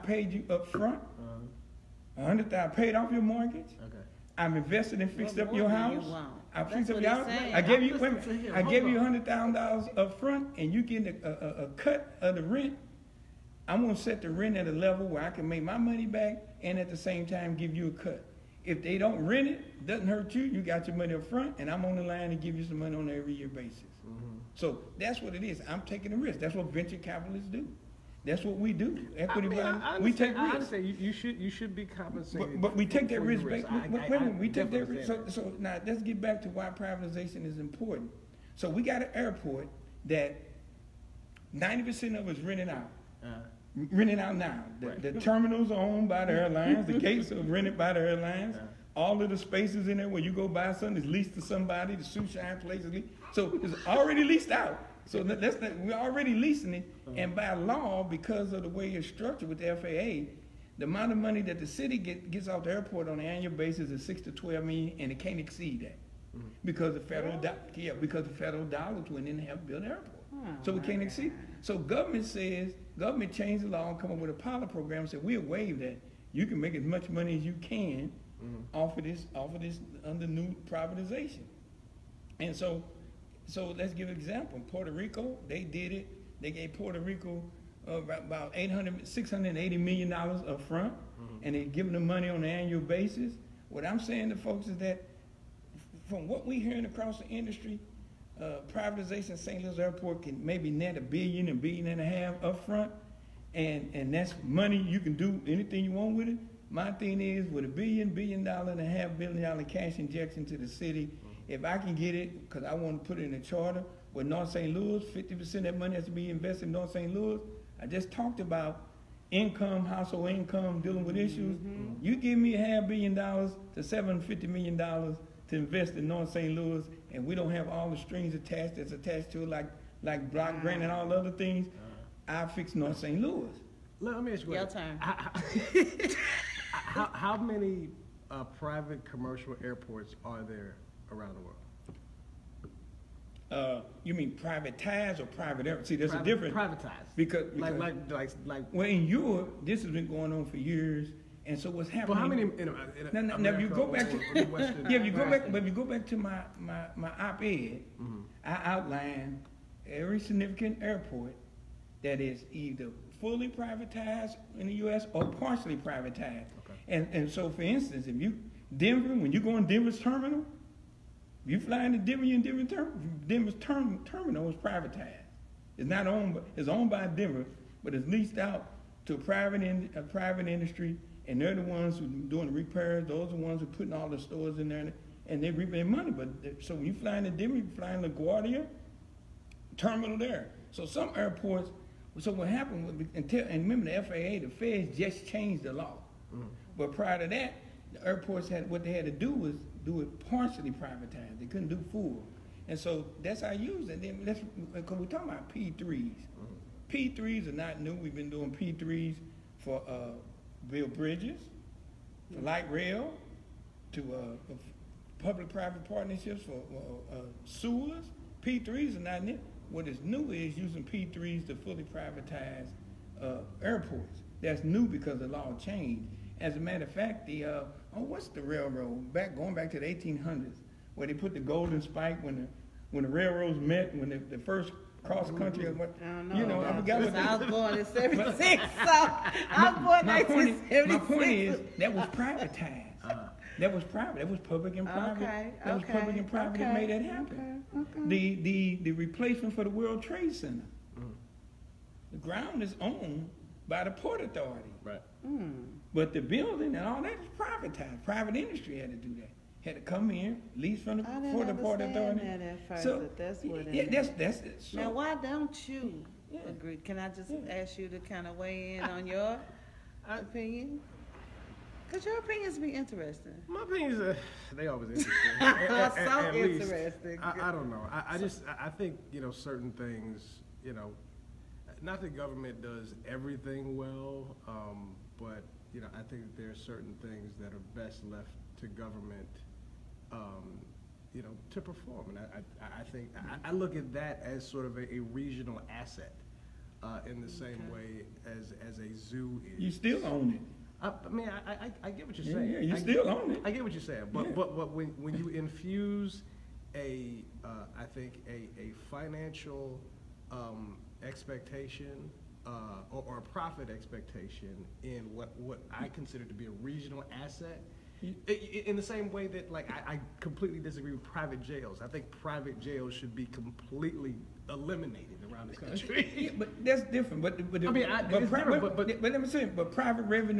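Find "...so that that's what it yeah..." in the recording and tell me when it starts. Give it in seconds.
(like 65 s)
262 s.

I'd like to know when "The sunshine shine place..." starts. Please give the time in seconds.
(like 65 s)
51 s.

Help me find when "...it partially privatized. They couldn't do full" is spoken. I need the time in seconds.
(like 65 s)
200 s.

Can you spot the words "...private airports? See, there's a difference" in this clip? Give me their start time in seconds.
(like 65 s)
145 s.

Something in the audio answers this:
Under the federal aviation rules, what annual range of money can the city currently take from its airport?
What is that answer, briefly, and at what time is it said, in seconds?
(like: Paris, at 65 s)
6 to 12 million, at 64 s.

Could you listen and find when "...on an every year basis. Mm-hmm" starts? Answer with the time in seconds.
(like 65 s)
22 s.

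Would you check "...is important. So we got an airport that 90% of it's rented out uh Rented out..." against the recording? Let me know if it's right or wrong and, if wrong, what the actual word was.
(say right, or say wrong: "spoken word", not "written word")
right.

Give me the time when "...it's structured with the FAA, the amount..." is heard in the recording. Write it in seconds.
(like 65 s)
58 s.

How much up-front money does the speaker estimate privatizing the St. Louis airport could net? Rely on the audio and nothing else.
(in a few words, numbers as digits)
a billion and a half.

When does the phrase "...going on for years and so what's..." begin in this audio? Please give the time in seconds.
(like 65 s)
150 s.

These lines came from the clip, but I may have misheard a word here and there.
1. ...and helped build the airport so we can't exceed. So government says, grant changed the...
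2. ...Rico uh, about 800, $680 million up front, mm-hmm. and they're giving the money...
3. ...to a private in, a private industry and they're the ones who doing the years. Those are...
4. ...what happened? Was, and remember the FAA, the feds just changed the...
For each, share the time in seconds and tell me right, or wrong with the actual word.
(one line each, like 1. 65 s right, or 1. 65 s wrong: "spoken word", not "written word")
1. 69 s wrong: "government", not "grant"
2. 86 s right
3. 179 s wrong: "repairs", not "years"
4. 192 s right.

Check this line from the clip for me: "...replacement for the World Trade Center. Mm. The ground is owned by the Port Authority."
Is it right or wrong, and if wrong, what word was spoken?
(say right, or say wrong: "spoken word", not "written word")
right.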